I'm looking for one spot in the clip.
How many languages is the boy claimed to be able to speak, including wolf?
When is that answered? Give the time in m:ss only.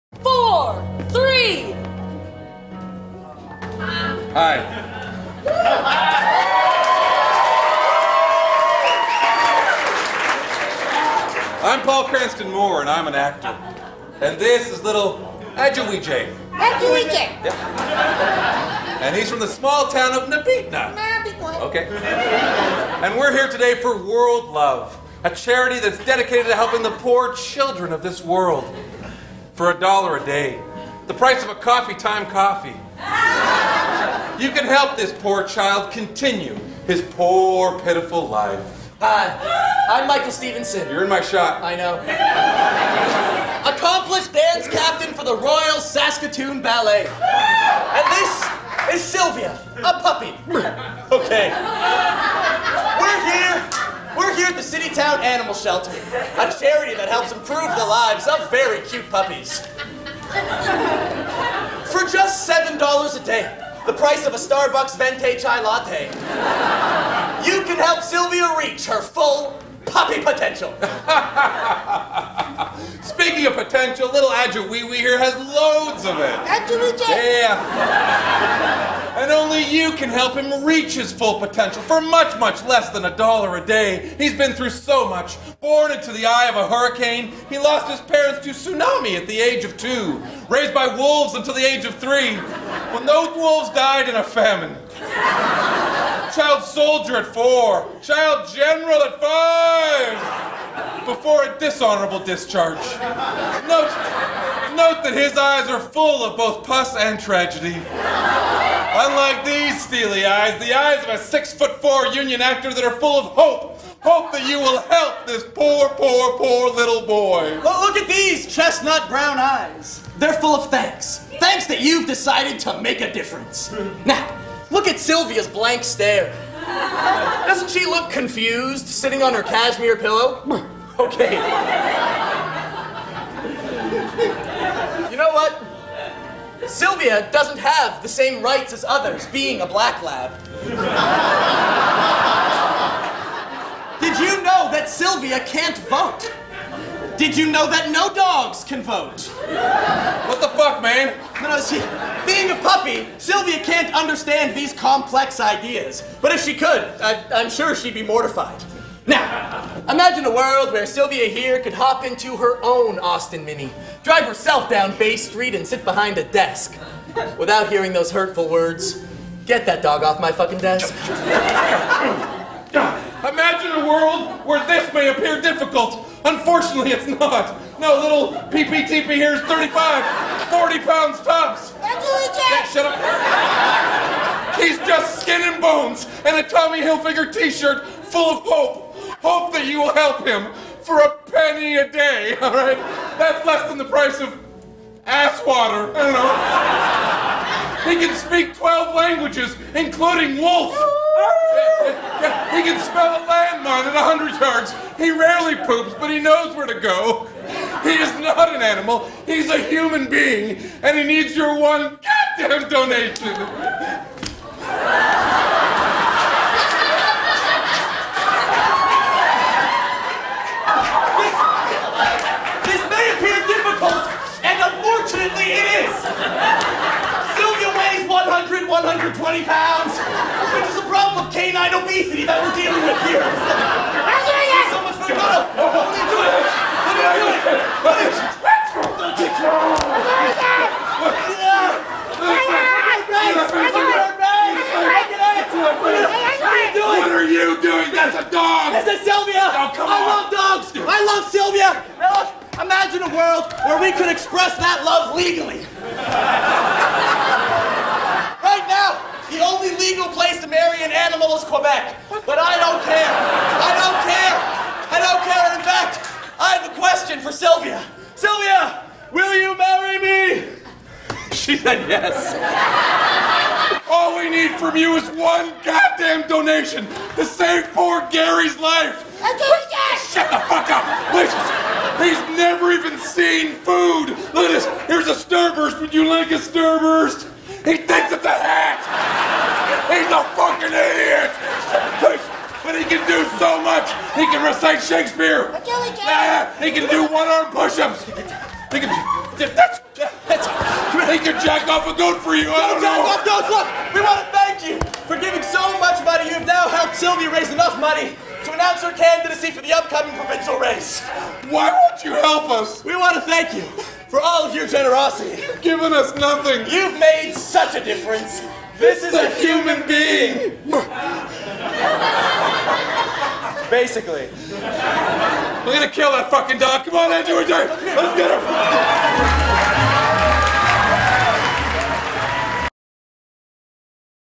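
3:18.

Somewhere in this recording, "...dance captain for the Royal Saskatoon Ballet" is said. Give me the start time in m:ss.
0:44.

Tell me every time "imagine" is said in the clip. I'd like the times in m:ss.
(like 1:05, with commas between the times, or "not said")
2:39, 2:53, 4:12.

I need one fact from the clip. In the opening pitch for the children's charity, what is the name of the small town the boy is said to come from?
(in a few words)
Nabitna.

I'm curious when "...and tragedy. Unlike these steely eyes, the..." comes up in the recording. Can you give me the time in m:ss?
1:46.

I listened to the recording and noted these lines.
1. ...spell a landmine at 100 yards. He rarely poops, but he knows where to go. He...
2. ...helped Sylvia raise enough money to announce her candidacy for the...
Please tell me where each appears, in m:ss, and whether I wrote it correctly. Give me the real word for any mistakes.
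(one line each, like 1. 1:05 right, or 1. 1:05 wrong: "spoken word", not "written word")
1. 3:22 right
2. 5:06 right.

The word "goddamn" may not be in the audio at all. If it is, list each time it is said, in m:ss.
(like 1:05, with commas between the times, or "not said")
3:32, 4:35.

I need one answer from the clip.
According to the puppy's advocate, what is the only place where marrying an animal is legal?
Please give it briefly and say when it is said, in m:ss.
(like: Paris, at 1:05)
Quebec, at 4:21.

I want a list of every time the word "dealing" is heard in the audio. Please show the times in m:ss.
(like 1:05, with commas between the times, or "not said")
3:52.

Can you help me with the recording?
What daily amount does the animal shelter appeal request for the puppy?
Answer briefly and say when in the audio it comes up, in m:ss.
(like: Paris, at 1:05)
$7, at 1:02.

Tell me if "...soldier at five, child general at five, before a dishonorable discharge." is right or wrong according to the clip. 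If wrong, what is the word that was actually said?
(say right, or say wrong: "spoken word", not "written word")
wrong: "four", not "five".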